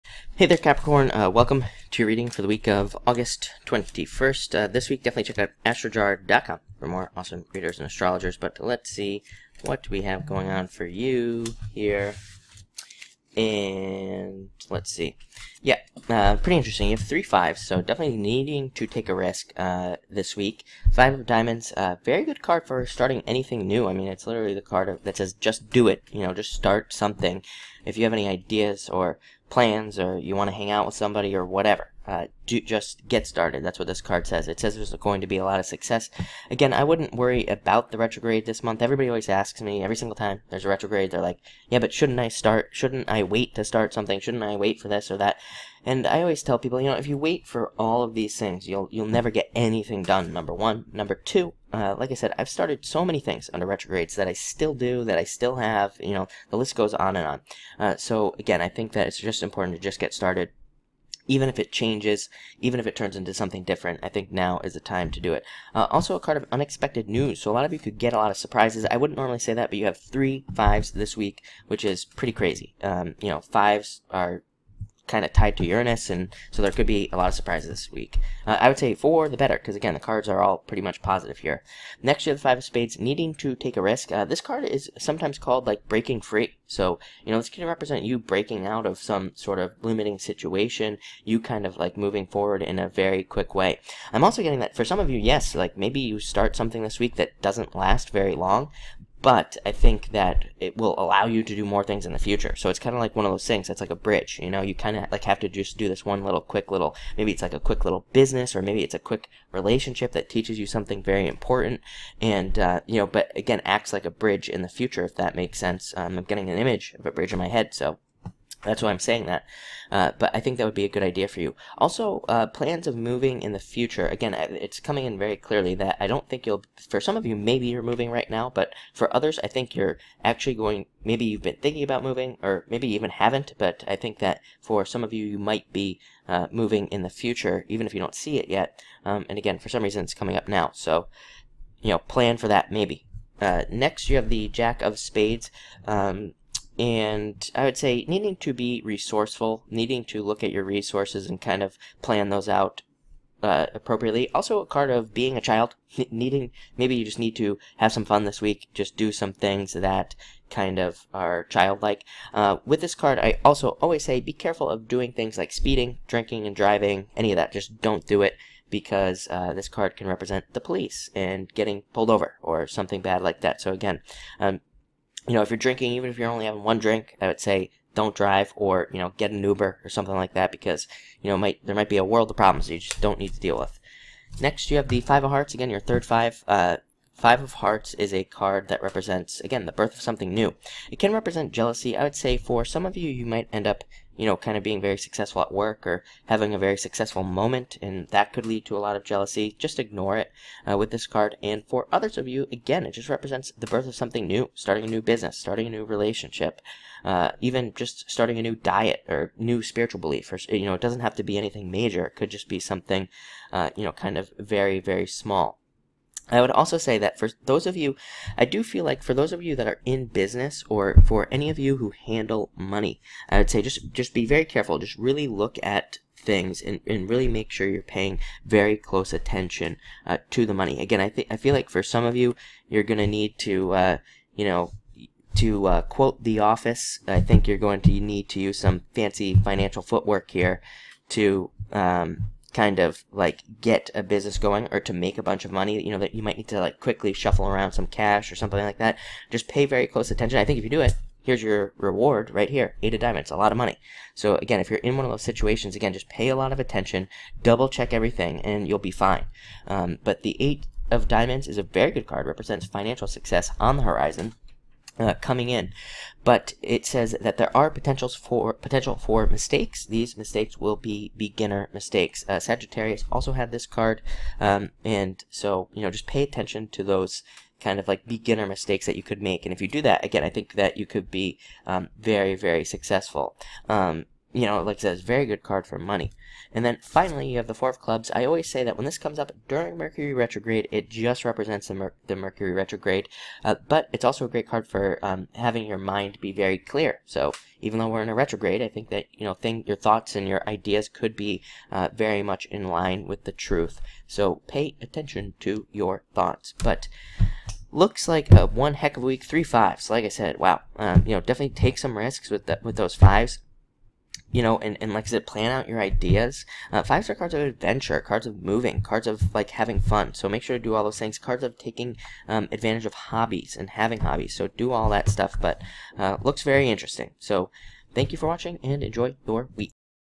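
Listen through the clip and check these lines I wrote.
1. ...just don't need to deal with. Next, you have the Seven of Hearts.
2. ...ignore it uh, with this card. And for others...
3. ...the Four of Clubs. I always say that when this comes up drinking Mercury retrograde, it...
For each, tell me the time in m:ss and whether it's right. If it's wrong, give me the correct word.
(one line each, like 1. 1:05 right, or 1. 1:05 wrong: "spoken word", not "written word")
1. 3:02 wrong: "Five", not "Seven"
2. 3:19 right
3. 4:47 wrong: "during", not "drinking".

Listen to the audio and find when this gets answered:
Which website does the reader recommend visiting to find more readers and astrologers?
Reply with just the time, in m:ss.
0:05.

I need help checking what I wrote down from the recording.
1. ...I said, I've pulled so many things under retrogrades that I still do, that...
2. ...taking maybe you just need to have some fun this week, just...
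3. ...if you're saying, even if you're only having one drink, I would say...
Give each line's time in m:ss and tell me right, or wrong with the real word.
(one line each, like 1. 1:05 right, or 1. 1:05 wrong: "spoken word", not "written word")
1. 0:52 wrong: "started", not "pulled"
2. 2:36 wrong: "needing", not "taking"
3. 2:55 wrong: "drinking", not "saying".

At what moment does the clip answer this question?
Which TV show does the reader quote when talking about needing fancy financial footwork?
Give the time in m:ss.
3:56.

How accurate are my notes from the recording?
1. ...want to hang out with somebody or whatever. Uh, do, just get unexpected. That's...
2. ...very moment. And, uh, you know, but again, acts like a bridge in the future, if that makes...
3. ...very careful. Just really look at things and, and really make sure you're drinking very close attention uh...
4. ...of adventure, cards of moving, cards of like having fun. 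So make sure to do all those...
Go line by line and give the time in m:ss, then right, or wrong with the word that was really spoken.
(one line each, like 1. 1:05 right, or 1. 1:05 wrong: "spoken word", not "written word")
1. 0:30 wrong: "started", not "unexpected"
2. 1:51 wrong: "important", not "moment"
3. 3:44 wrong: "paying", not "drinking"
4. 5:17 right.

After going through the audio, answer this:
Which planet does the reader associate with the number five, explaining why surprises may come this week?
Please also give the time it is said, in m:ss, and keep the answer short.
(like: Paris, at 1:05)
Uranus, at 1:15.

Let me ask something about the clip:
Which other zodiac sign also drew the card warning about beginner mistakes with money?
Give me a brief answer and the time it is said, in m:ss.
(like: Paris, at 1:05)
Sagittarius, at 4:32.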